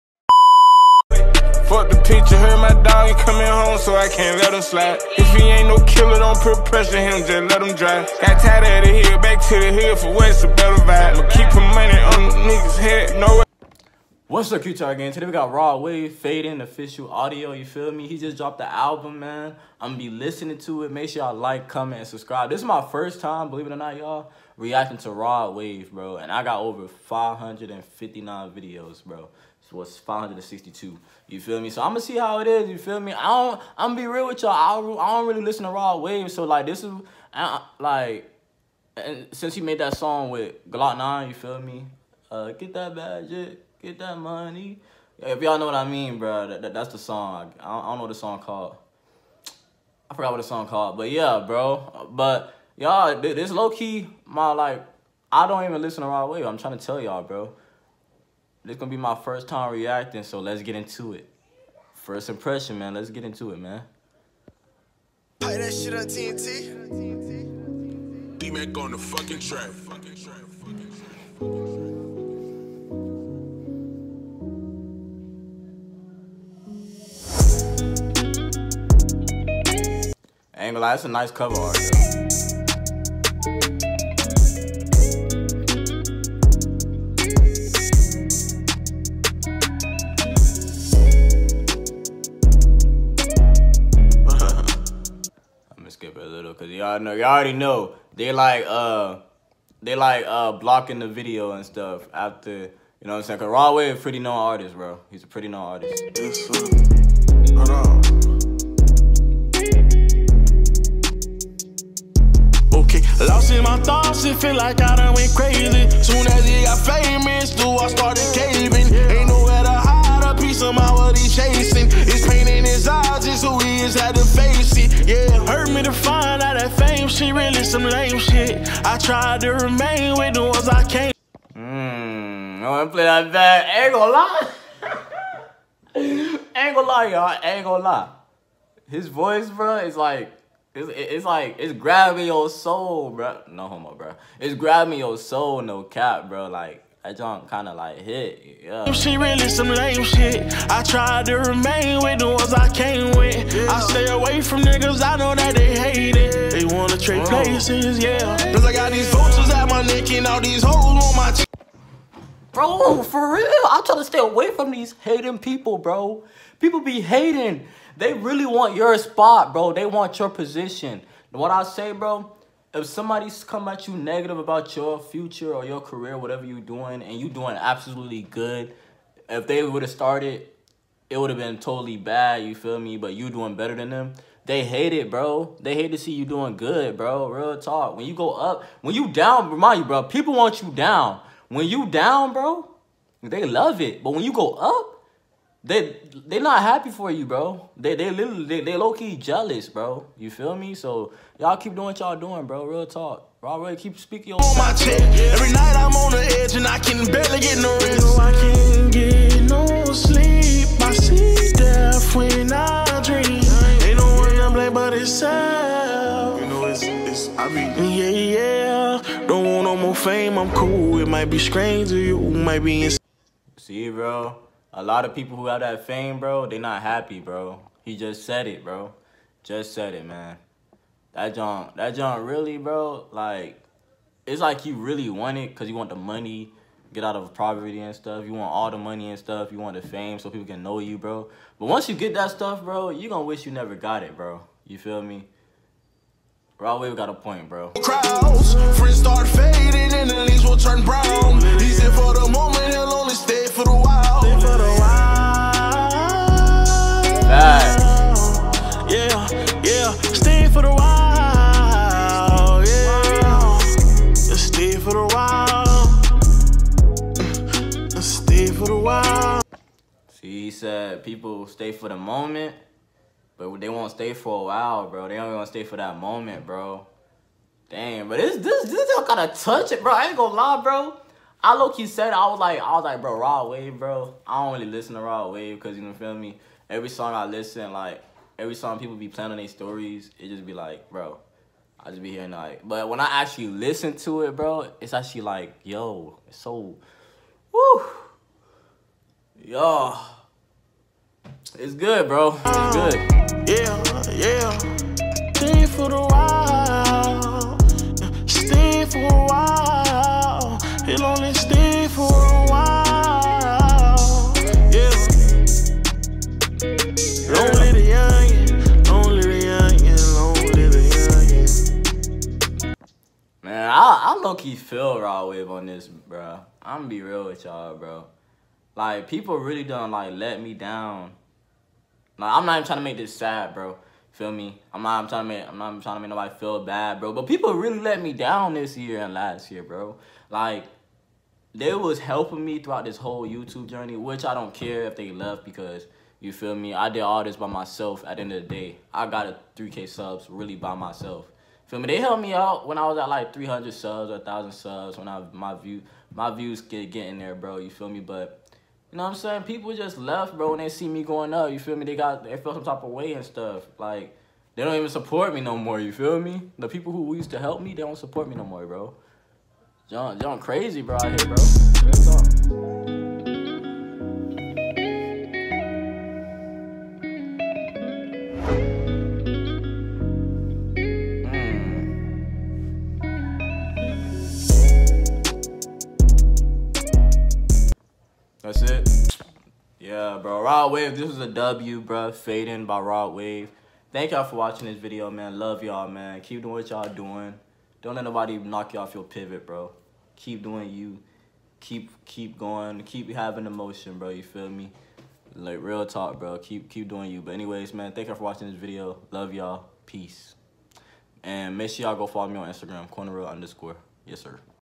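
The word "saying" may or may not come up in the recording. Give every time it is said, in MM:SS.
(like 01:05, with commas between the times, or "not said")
01:43, 05:59.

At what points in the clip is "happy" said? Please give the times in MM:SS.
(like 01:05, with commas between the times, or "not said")
03:16, 03:46.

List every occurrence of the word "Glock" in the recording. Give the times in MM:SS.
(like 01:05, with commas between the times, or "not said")
00:40.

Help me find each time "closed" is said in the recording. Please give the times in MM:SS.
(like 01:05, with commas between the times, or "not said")
not said.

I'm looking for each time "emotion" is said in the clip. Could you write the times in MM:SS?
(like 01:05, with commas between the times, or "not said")
06:43.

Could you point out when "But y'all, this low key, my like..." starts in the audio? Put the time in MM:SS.
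00:52.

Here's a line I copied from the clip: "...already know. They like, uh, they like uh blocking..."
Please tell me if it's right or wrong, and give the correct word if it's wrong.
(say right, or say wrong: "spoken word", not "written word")
right.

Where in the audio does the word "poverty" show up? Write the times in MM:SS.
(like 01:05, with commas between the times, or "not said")
03:57.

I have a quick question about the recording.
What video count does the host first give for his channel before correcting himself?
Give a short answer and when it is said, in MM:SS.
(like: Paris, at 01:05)
559, at 00:26.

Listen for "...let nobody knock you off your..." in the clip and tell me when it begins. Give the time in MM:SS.
06:37.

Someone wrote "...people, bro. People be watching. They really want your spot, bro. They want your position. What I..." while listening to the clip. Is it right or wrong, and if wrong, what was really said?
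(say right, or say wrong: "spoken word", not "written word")
wrong: "hating", not "watching".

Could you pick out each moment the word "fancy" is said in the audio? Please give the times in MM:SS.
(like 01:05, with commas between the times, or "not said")
not said.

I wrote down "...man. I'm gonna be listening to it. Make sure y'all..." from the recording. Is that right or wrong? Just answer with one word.
right.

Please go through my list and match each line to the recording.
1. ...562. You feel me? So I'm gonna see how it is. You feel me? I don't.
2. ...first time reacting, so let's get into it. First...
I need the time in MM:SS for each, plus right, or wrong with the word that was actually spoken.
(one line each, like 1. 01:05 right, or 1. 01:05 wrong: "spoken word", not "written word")
1. 00:29 right
2. 00:59 right.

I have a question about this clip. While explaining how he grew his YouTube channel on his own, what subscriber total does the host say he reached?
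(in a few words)
3K.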